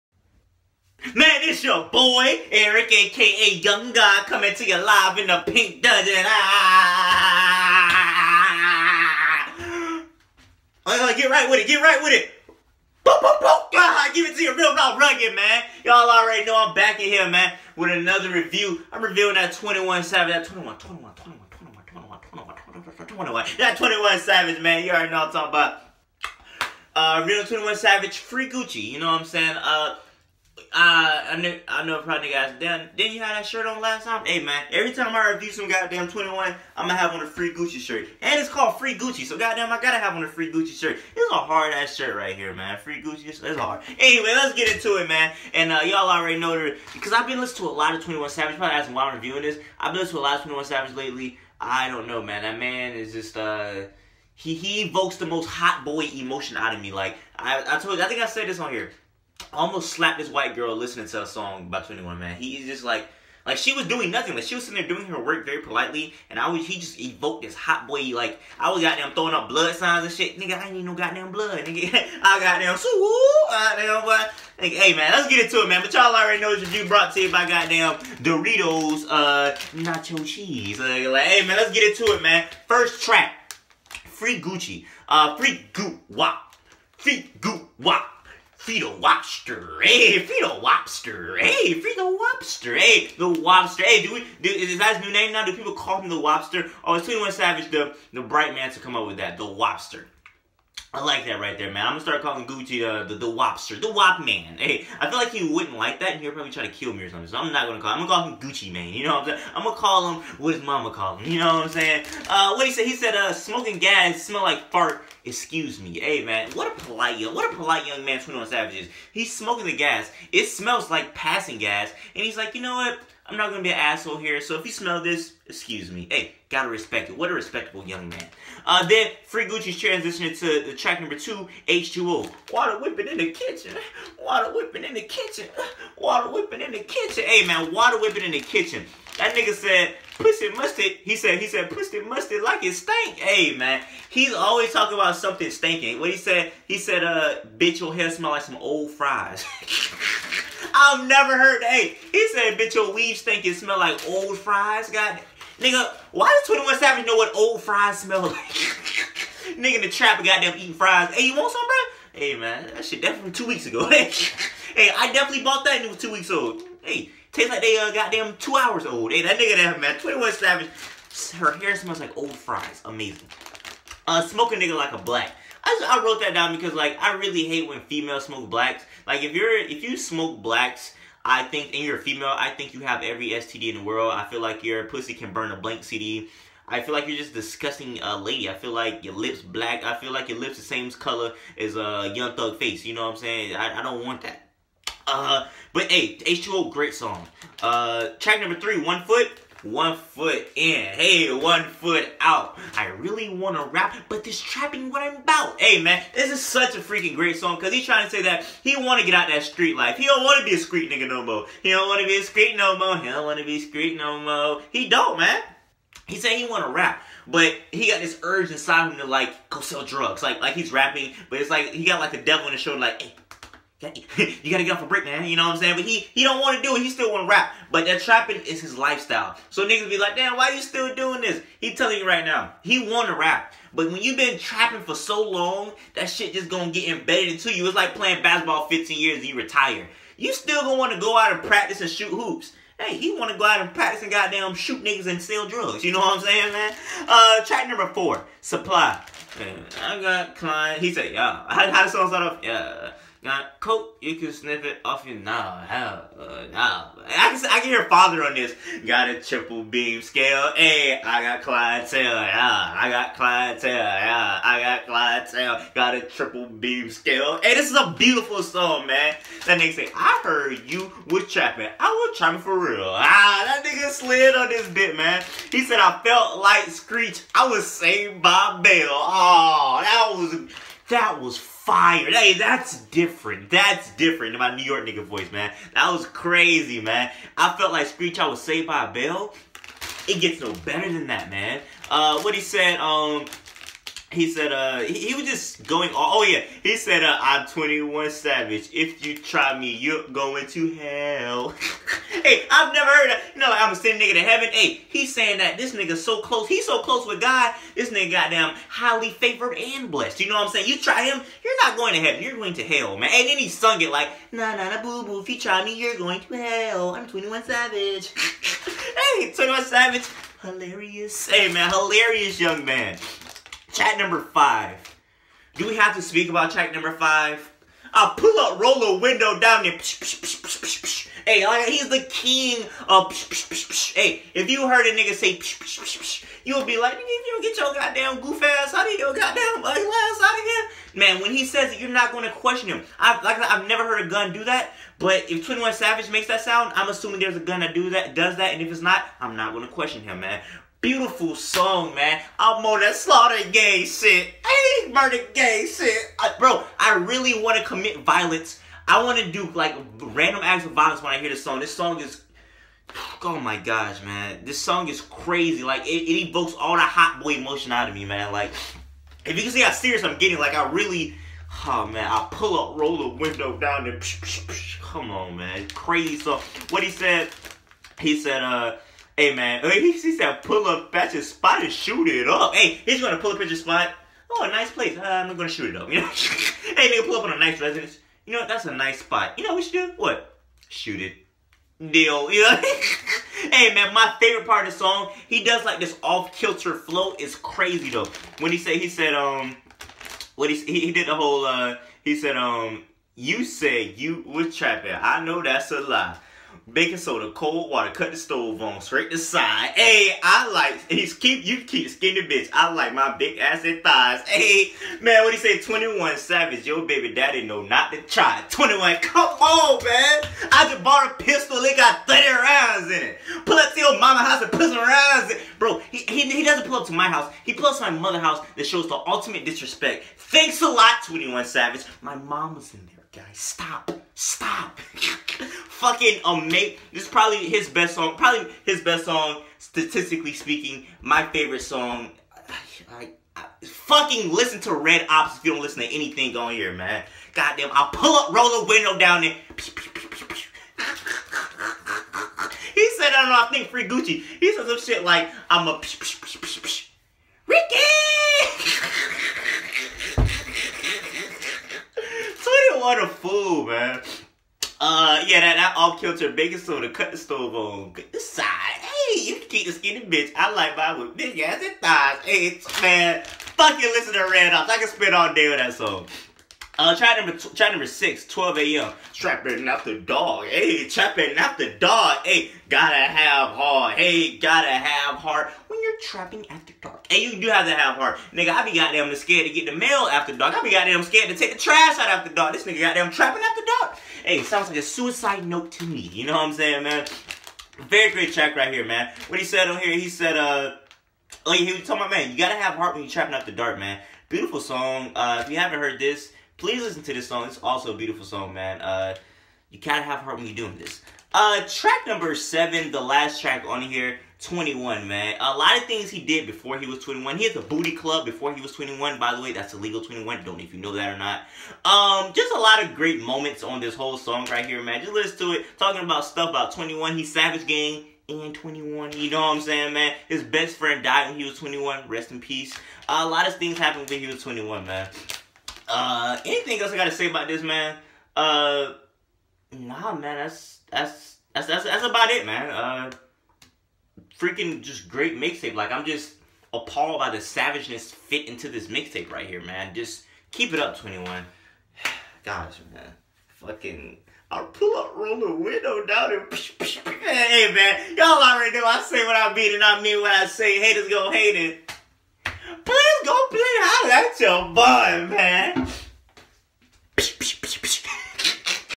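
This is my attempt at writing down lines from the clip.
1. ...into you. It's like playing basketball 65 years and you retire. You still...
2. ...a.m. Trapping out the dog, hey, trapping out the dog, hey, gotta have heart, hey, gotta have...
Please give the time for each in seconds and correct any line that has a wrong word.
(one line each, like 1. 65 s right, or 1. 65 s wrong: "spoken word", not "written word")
1. 237 s wrong: "15", not "65"
2. 478 s right.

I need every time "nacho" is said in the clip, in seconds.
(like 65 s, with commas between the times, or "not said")
79 s.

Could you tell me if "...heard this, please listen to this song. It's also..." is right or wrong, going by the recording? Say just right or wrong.
right.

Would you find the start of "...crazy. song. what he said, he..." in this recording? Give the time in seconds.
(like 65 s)
375 s.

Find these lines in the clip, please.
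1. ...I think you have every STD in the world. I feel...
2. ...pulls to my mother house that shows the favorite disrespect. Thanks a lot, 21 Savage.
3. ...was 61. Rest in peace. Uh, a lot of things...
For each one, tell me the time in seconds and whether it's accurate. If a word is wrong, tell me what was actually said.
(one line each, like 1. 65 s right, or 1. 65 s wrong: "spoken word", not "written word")
1. 182 s right
2. 427 s wrong: "ultimate", not "favorite"
3. 531 s wrong: "21", not "61".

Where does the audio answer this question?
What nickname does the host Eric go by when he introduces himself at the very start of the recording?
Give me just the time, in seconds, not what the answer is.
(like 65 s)
3 s.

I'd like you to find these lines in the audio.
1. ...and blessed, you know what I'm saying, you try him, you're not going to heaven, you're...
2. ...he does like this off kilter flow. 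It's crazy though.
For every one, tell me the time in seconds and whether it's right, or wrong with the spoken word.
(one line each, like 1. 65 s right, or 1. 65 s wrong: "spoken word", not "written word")
1. 309 s right
2. 395 s right.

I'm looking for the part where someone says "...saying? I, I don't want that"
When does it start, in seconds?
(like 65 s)
193 s.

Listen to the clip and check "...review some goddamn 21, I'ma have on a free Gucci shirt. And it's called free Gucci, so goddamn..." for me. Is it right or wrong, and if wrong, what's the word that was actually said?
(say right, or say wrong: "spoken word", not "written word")
right.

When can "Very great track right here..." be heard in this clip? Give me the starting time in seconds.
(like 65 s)
497 s.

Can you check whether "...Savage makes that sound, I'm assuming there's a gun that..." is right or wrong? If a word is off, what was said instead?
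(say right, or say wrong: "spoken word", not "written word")
right.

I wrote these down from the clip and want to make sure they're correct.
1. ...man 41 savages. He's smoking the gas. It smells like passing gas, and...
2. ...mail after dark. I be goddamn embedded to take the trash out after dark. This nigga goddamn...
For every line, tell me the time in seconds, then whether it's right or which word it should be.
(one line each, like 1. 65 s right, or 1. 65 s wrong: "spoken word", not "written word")
1. 118 s wrong: "21", not "41"
2. 489 s wrong: "scared", not "embedded".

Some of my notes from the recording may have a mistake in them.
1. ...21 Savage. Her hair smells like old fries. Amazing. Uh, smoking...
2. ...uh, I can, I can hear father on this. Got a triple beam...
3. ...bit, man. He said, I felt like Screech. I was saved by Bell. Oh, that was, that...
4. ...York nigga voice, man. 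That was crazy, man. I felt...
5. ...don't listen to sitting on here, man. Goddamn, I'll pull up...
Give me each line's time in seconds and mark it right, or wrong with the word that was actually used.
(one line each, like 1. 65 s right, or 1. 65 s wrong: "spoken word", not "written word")
1. 169 s right
2. 256 s right
3. 274 s right
4. 284 s right
5. 445 s wrong: "anything", not "sitting".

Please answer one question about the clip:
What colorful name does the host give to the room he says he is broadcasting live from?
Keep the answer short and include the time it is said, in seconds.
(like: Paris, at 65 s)
the pink dungeon, at 5 s.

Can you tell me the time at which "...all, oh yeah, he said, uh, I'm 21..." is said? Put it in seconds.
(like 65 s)
295 s.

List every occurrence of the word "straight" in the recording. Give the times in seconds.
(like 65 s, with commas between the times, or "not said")
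408 s.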